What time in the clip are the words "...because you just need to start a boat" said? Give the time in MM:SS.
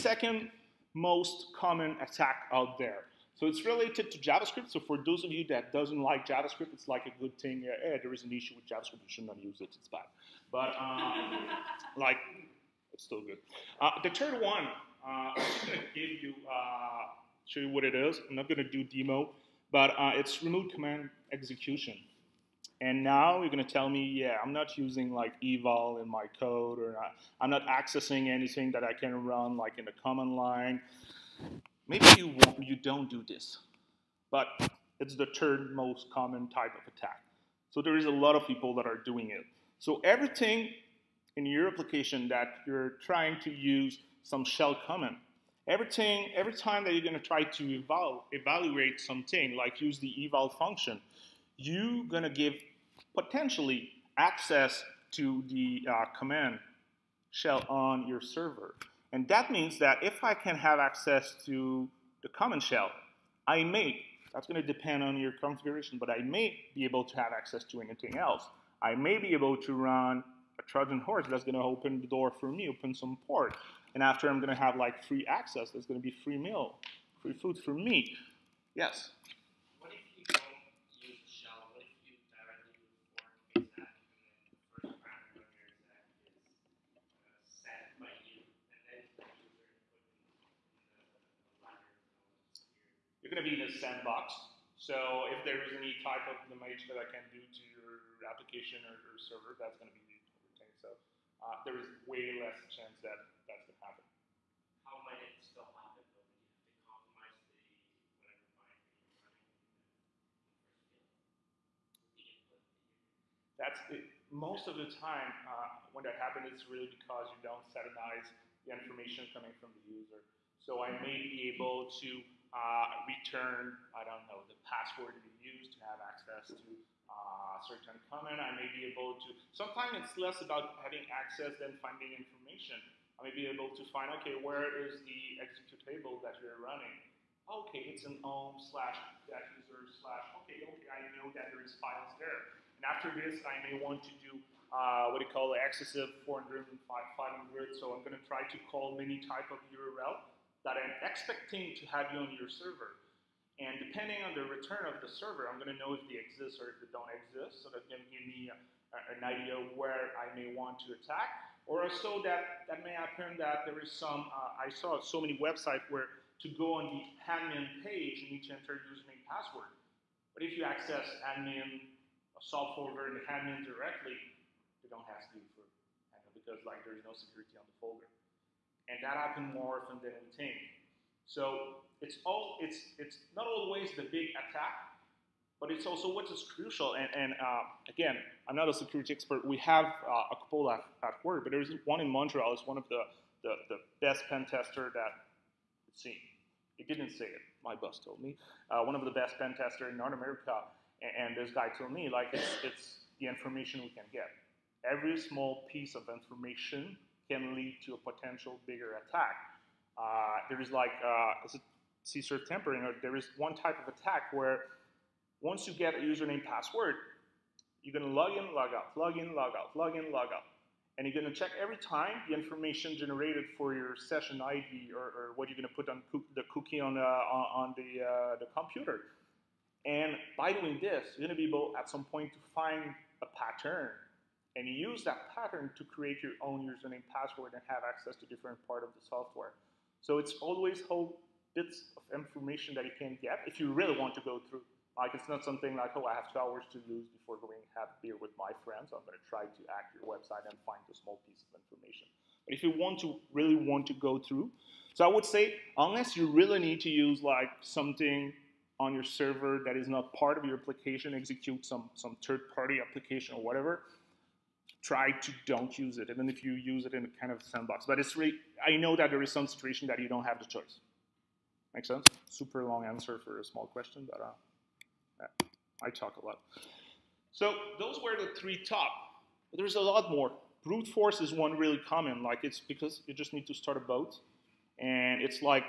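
04:42.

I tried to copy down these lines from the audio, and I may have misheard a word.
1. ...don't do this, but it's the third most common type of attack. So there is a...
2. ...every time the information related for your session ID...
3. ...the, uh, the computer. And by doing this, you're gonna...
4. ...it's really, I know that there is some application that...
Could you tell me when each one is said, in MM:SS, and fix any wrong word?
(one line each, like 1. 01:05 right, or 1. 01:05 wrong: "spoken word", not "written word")
1. 00:32 right
2. 03:41 wrong: "generated", not "related"
3. 03:47 right
4. 04:27 wrong: "situation", not "application".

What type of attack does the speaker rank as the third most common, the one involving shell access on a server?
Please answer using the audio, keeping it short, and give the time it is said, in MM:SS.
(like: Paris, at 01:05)
Remote command execution, at 00:20.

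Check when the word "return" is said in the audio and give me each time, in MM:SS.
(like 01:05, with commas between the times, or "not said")
02:03, 02:34.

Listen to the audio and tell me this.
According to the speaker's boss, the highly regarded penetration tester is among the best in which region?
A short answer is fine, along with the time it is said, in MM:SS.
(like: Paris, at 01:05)
North America, at 03:19.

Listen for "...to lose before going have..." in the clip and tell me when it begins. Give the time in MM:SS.
04:06.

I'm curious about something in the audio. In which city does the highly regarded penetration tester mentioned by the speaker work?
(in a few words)
Montreal.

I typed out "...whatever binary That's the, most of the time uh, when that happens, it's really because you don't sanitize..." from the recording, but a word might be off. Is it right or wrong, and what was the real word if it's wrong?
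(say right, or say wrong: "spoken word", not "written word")
right.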